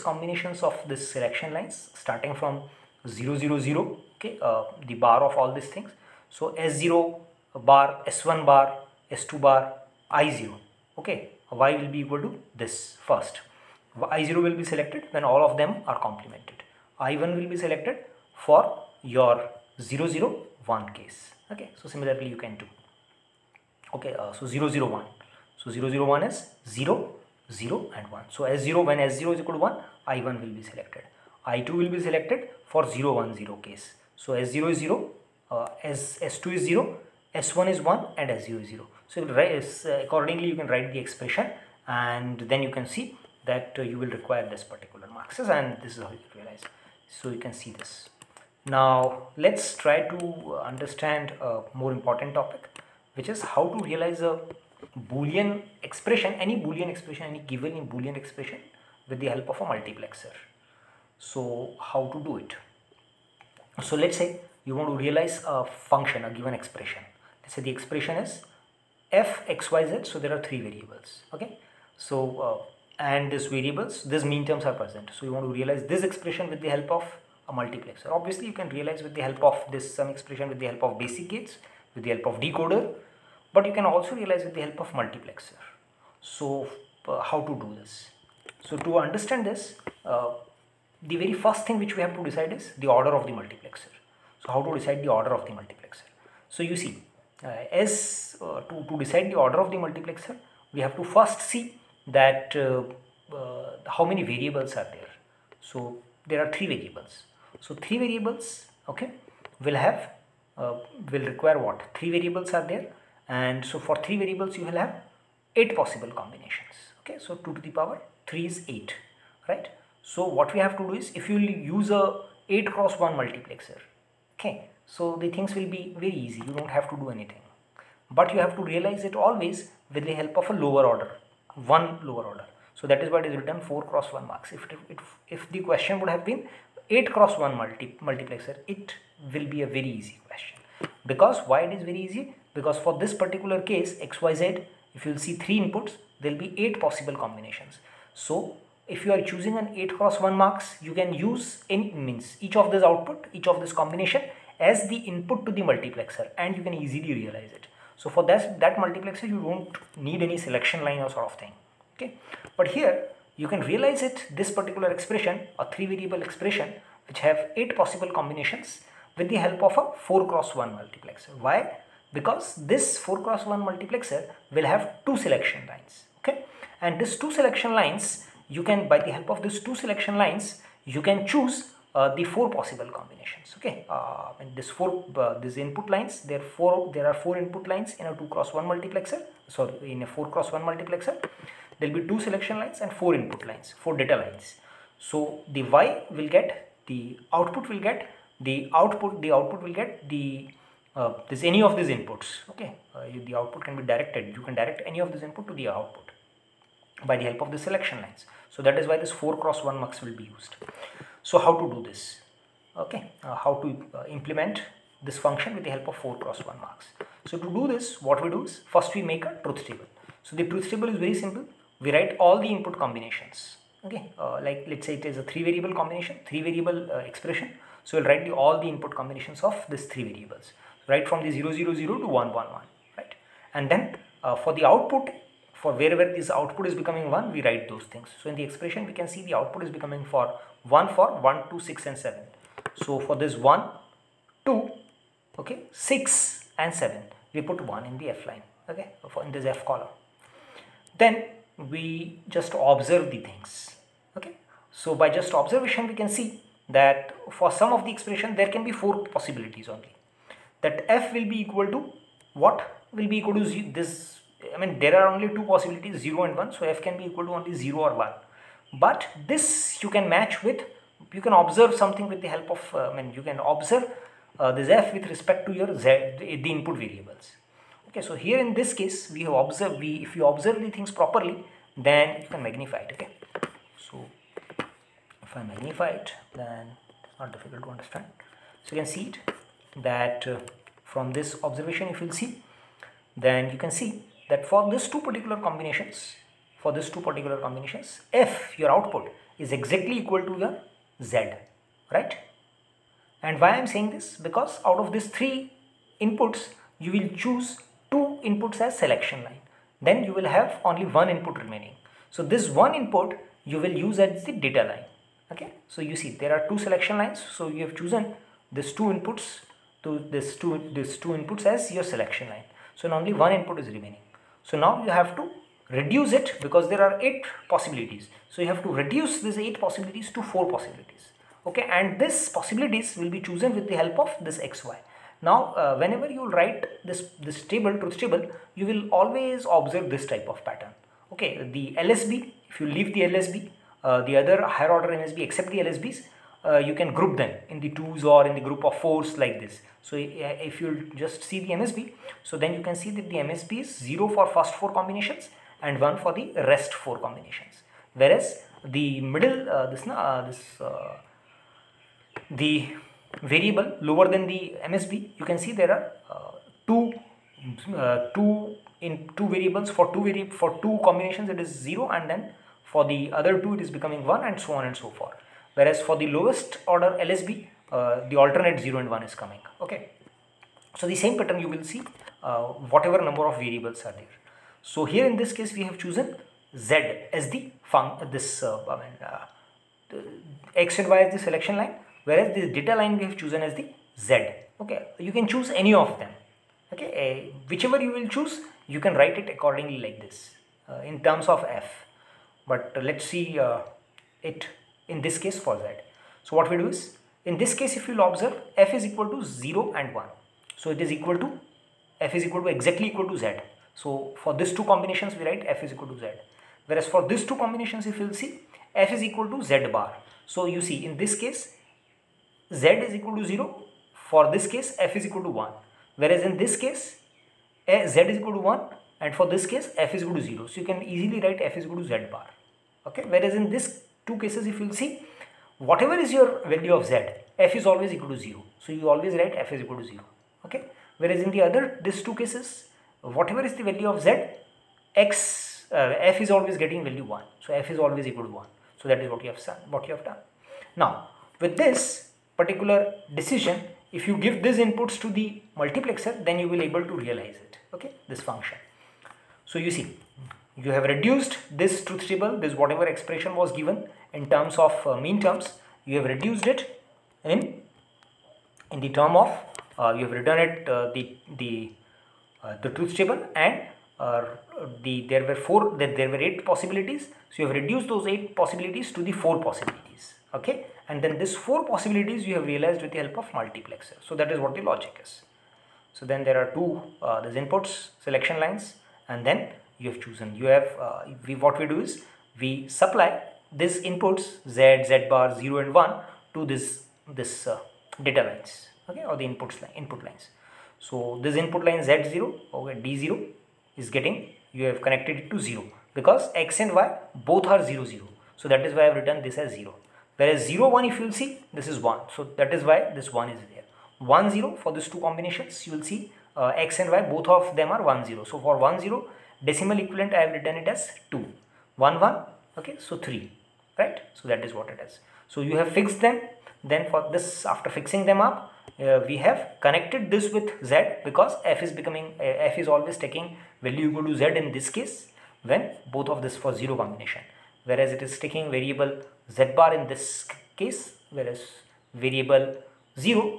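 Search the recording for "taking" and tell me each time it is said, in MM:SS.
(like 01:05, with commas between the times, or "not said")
08:53, 08:58.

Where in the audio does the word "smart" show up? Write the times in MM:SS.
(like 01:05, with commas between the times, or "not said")
not said.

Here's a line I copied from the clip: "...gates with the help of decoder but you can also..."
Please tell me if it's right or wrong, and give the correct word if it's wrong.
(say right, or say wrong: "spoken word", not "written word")
right.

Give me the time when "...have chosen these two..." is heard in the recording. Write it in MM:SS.
05:17.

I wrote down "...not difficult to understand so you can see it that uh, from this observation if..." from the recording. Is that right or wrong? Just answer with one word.
right.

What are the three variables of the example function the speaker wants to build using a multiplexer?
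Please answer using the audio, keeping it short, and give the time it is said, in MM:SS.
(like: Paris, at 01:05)
x, y, z, at 01:09.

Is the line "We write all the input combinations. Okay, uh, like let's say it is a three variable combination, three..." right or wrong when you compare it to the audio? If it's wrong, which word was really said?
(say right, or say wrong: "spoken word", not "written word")
right.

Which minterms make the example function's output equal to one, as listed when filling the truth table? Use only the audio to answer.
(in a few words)
1, 2, 6 and 7.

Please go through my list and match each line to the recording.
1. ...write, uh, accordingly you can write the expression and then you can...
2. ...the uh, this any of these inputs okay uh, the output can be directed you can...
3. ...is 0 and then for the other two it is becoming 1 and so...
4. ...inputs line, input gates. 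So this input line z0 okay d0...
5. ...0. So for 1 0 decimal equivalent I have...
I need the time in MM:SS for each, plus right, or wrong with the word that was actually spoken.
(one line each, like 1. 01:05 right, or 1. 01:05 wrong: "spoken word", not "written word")
1. 00:39 right
2. 03:20 right
3. 06:11 right
4. 08:19 wrong: "lines", not "gates"
5. 08:38 right.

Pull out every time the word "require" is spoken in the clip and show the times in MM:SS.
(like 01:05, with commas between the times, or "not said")
00:44, 01:51.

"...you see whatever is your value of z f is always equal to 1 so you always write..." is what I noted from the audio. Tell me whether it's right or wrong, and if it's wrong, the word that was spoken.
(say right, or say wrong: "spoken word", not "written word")
wrong: "0", not "1".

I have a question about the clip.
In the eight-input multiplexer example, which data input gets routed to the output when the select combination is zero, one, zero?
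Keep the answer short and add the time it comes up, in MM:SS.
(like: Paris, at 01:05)
I2, at 00:31.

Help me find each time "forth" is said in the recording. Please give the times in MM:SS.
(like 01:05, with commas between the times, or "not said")
06:14.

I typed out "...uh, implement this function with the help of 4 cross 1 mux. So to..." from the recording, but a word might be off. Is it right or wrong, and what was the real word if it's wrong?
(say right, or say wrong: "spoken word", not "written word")
right.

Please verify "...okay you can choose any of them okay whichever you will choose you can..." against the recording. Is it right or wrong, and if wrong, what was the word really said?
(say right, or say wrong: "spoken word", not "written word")
right.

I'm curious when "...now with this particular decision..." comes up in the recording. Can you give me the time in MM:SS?
07:30.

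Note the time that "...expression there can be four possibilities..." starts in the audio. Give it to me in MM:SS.
04:17.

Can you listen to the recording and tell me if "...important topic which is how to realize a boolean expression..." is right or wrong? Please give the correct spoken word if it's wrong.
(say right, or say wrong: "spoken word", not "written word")
right.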